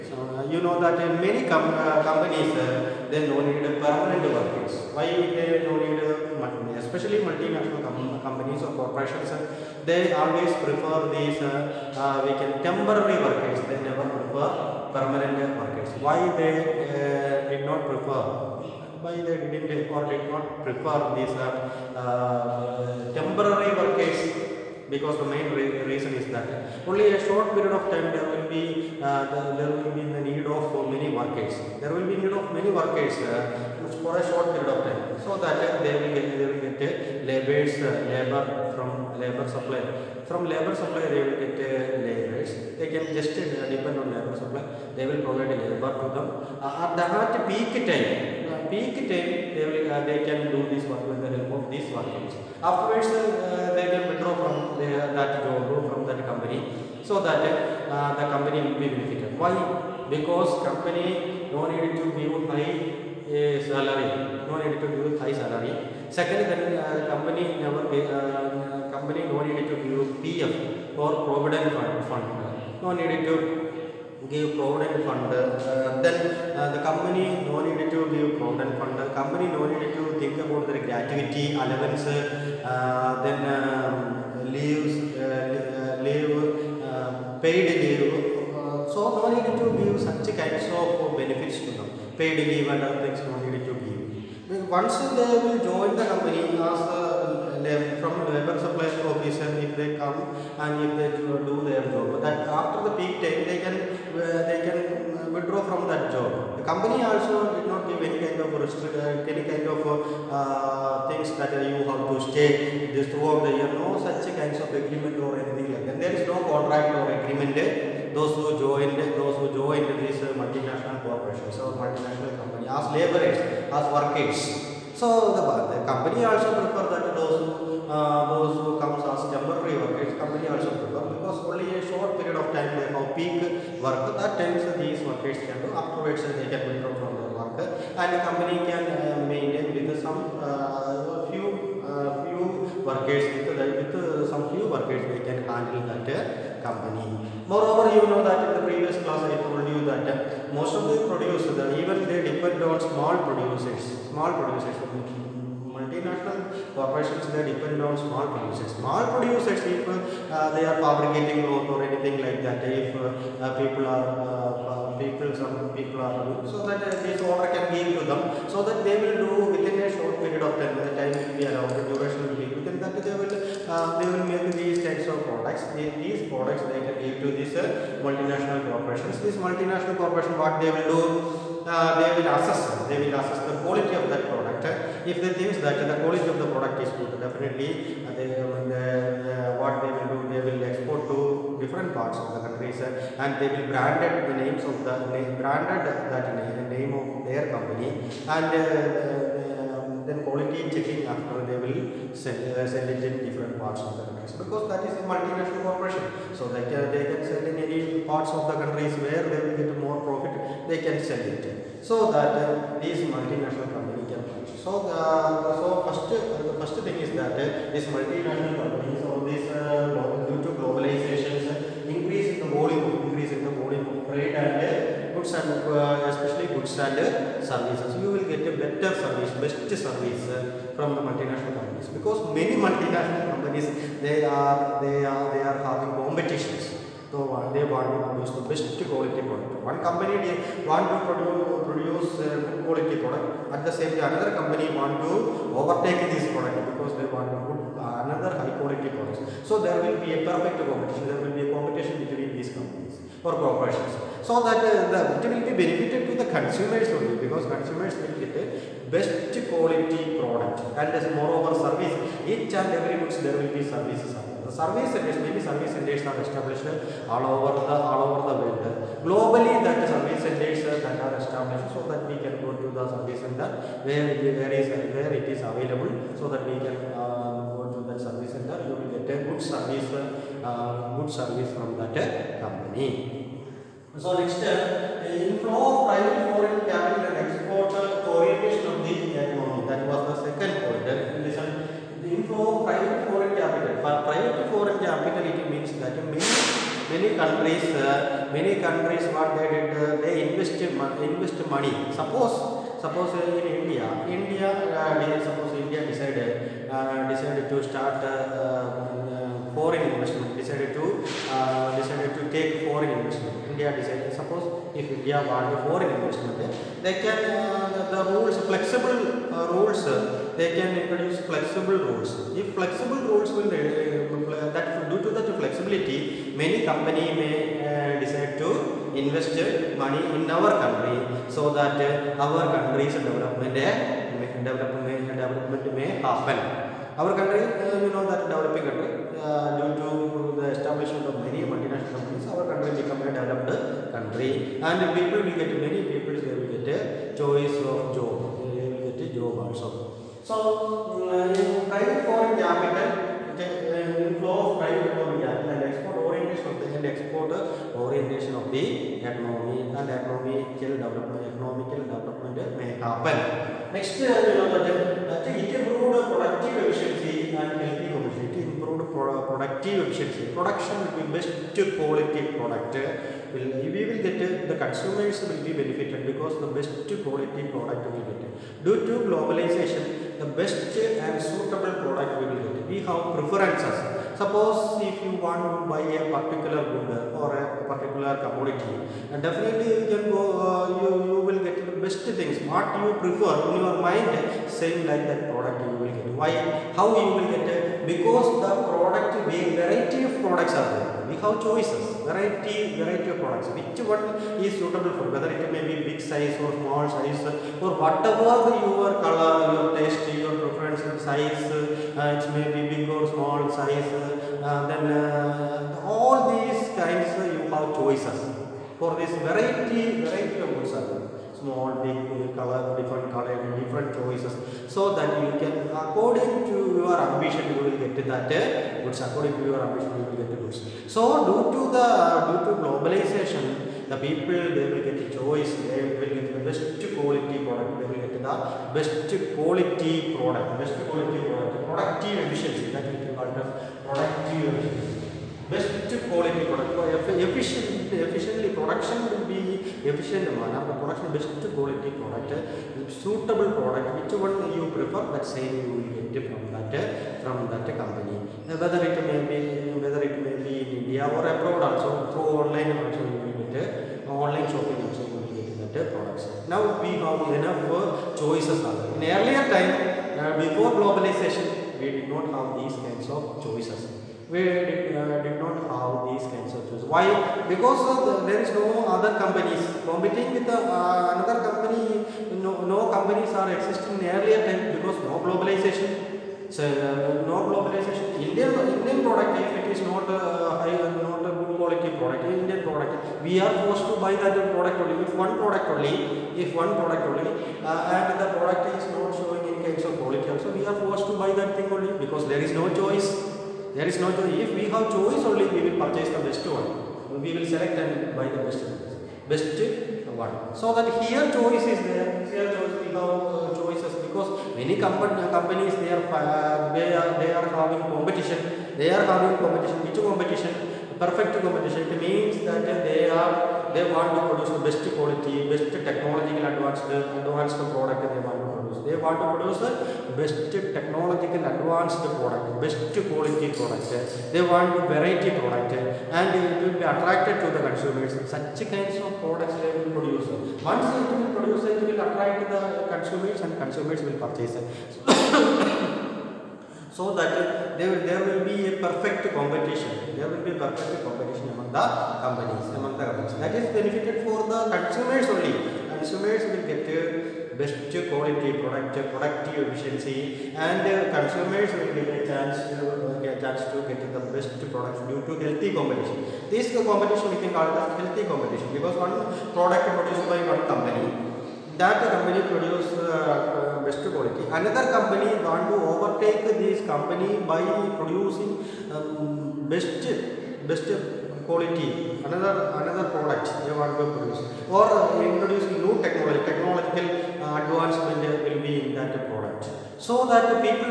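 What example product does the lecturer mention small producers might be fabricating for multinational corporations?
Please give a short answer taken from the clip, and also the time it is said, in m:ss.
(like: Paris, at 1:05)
Cloth, at 2:41.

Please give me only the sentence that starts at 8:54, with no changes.
They want variety product and it will be attracted to the consumers.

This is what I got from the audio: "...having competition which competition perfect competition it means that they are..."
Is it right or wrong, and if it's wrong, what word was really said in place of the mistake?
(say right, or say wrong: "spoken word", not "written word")
right.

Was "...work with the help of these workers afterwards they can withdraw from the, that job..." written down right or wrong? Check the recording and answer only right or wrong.
right.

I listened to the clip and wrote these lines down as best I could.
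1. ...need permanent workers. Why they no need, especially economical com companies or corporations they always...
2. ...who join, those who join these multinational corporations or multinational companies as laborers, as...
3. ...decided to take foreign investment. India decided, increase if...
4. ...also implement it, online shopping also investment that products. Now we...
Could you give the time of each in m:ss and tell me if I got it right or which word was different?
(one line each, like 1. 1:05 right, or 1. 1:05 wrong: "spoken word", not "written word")
1. 0:03 wrong: "multinational", not "economical"
2. 1:58 right
3. 5:11 wrong: "suppose", not "increase"
4. 7:42 wrong: "implement", not "investment".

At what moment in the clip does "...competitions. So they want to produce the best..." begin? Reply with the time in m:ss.
3:56.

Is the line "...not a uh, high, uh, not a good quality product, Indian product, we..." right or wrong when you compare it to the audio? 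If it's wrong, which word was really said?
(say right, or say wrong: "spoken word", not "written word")
right.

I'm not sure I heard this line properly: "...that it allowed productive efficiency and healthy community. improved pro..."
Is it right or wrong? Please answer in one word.
wrong.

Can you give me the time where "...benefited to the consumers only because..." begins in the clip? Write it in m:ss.
4:15.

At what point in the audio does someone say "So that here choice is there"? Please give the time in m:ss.
8:30.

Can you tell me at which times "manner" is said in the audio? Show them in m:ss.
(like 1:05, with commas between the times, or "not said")
7:30.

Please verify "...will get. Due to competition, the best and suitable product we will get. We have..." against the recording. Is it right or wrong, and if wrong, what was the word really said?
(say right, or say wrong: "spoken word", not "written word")
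wrong: "globalization", not "competition".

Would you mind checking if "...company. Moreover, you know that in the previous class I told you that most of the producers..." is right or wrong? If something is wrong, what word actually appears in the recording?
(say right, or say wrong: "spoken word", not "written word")
right.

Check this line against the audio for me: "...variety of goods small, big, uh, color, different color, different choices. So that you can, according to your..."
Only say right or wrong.
right.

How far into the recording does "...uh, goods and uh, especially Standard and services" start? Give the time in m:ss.
3:44.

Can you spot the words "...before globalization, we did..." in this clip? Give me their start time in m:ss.
7:50.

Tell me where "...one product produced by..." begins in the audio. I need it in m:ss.
9:28.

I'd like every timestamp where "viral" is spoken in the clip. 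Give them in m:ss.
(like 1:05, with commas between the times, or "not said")
not said.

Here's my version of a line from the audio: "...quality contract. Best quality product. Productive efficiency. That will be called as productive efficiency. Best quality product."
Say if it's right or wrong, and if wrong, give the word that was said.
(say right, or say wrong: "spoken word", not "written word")
wrong: "product", not "contract".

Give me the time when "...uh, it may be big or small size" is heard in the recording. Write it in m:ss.
6:51.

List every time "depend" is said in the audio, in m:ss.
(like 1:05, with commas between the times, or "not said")
0:43, 2:32, 2:37.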